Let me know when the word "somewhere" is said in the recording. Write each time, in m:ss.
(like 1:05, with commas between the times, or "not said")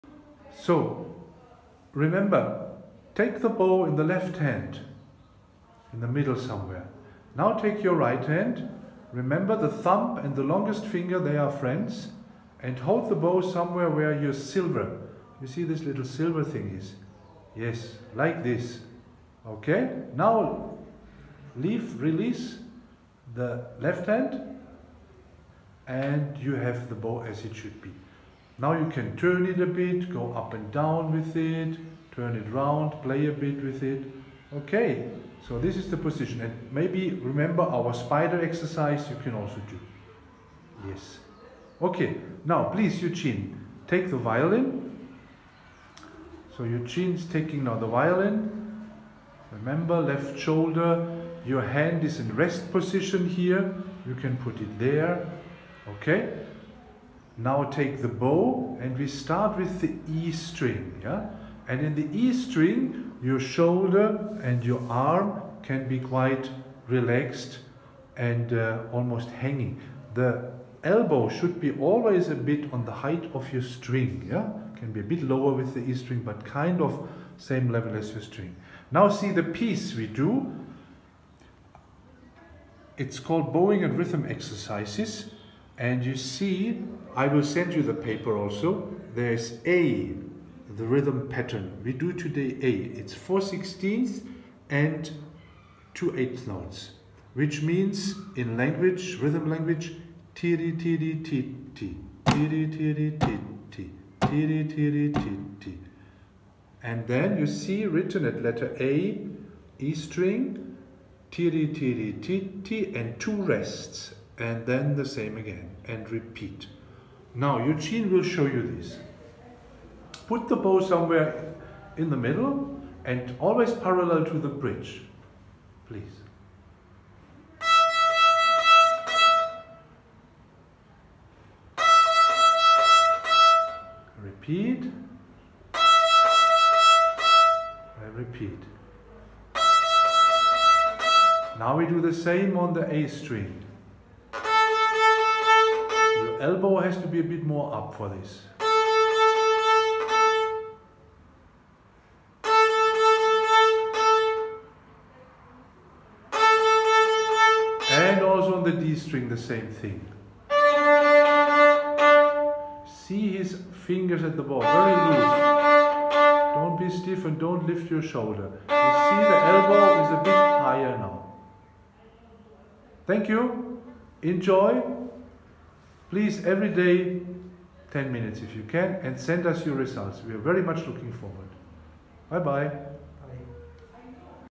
0:06, 0:13, 2:00.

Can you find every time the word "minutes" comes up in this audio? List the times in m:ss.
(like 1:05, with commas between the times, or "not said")
2:58.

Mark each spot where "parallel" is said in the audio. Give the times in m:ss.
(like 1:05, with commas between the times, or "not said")
2:03.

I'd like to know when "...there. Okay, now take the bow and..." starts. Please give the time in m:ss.
0:54.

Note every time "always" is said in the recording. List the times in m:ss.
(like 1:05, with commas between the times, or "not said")
1:11, 2:03.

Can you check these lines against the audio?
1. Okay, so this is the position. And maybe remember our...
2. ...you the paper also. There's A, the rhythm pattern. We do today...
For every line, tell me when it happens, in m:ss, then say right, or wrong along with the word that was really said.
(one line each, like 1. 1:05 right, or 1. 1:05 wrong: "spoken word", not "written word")
1. 0:34 right
2. 1:27 right.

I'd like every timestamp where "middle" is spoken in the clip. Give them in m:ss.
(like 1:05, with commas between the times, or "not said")
0:06, 2:02.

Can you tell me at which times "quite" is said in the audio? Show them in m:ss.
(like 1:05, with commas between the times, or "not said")
1:05.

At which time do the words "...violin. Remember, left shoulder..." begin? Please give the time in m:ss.
0:47.